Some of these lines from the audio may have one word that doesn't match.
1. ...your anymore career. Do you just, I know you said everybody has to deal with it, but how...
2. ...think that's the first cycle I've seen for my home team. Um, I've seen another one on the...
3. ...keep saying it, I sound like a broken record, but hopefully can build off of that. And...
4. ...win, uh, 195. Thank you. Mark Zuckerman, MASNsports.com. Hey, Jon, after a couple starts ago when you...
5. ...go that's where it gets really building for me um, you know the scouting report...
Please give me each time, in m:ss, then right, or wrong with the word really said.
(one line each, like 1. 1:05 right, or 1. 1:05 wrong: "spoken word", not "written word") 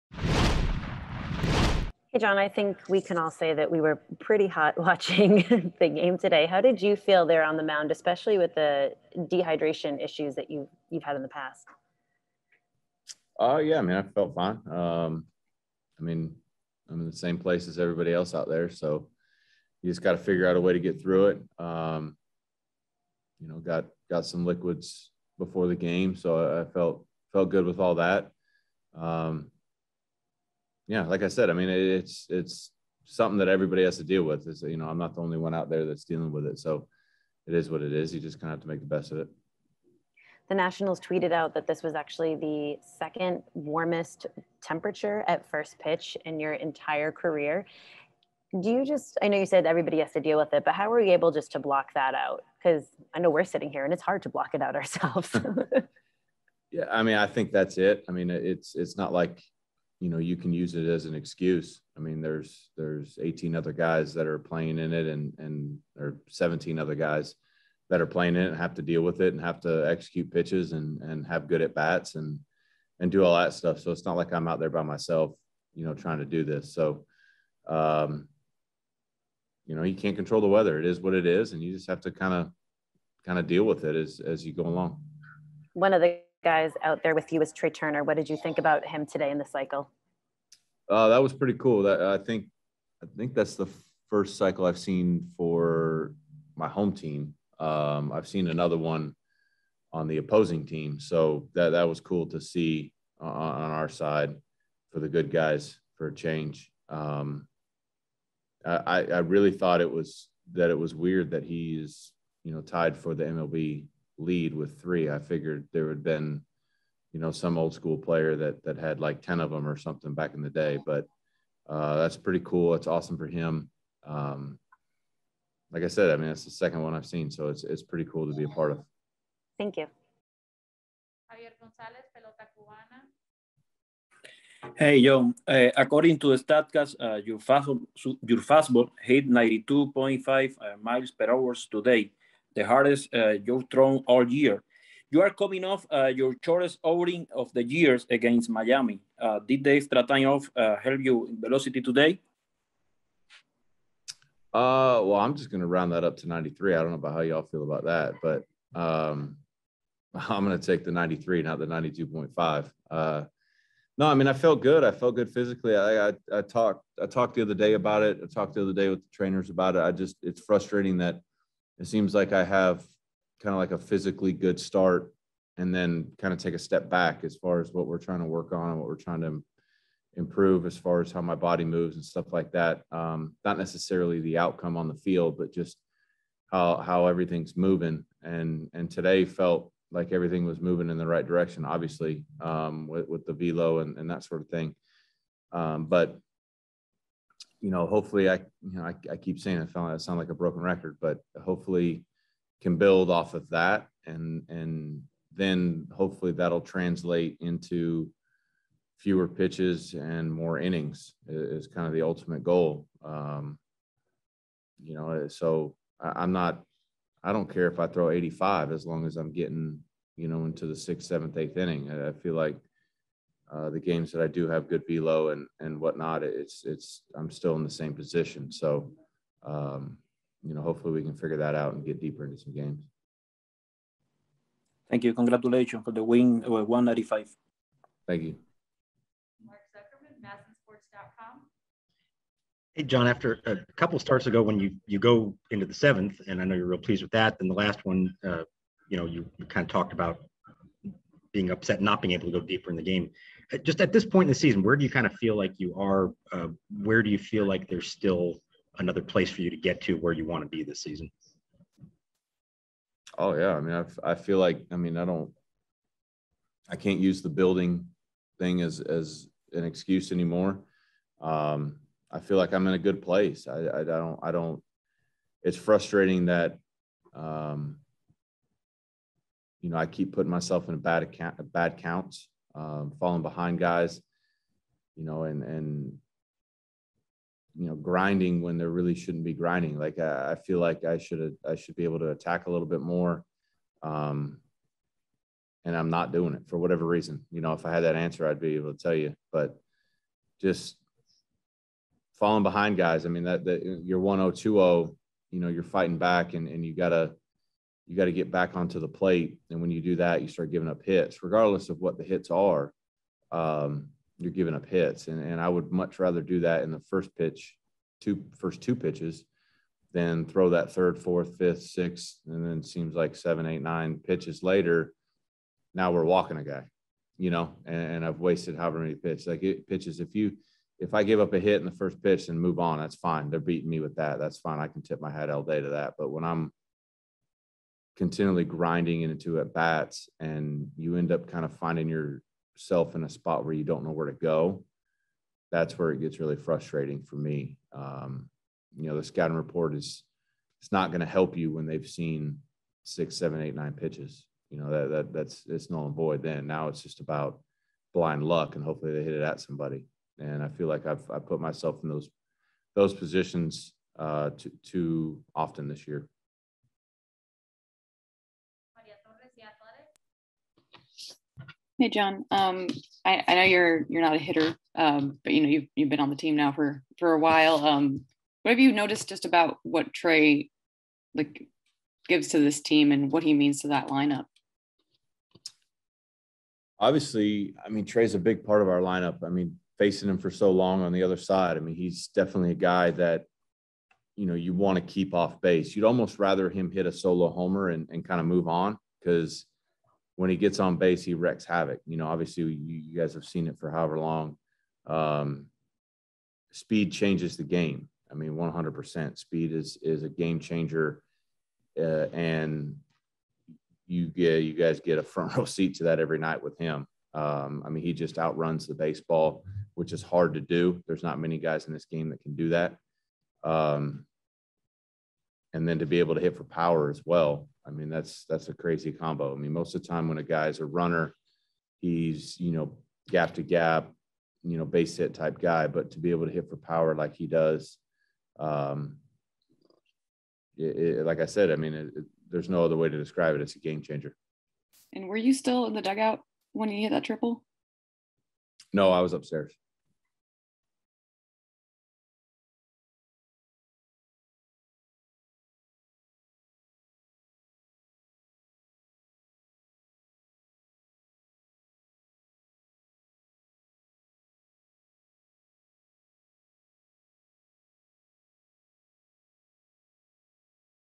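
1. 0:46 wrong: "entire", not "anymore"
2. 1:33 right
3. 3:19 right
4. 3:56 right
5. 5:44 wrong: "frustrating", not "building".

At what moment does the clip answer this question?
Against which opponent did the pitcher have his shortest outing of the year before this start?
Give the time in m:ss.
2:28.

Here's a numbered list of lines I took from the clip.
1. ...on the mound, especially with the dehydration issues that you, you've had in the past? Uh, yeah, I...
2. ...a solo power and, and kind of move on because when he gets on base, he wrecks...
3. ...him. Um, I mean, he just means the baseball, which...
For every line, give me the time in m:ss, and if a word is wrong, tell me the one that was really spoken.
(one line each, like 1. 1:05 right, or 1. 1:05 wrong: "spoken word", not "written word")
1. 0:07 right
2. 6:36 wrong: "homer", not "power"
3. 6:56 wrong: "outruns", not "means".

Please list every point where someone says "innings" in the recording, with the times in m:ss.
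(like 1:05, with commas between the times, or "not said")
3:30, 3:41.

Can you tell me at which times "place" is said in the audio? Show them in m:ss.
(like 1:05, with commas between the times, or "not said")
0:17, 4:19, 4:33.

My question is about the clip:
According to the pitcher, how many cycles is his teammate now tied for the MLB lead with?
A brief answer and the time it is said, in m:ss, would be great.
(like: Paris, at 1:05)
3, at 1:54.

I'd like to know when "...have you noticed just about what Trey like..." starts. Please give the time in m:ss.
6:18.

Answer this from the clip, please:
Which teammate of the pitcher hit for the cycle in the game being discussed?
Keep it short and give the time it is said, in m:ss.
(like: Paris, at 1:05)
Trey Turner, at 1:27.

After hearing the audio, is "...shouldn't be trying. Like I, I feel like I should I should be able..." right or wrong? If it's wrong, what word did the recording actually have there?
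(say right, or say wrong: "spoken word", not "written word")
wrong: "grinding", not "trying".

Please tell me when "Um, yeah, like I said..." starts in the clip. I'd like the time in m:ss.
0:28.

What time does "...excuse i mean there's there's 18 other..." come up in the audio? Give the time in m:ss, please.
1:01.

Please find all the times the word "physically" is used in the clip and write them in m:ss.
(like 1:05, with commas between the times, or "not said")
2:45, 2:53.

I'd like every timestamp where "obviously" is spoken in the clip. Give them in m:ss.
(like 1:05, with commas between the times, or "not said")
3:11, 6:26, 6:42.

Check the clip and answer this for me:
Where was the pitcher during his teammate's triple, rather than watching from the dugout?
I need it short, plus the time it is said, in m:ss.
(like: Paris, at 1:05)
Upstairs, at 7:29.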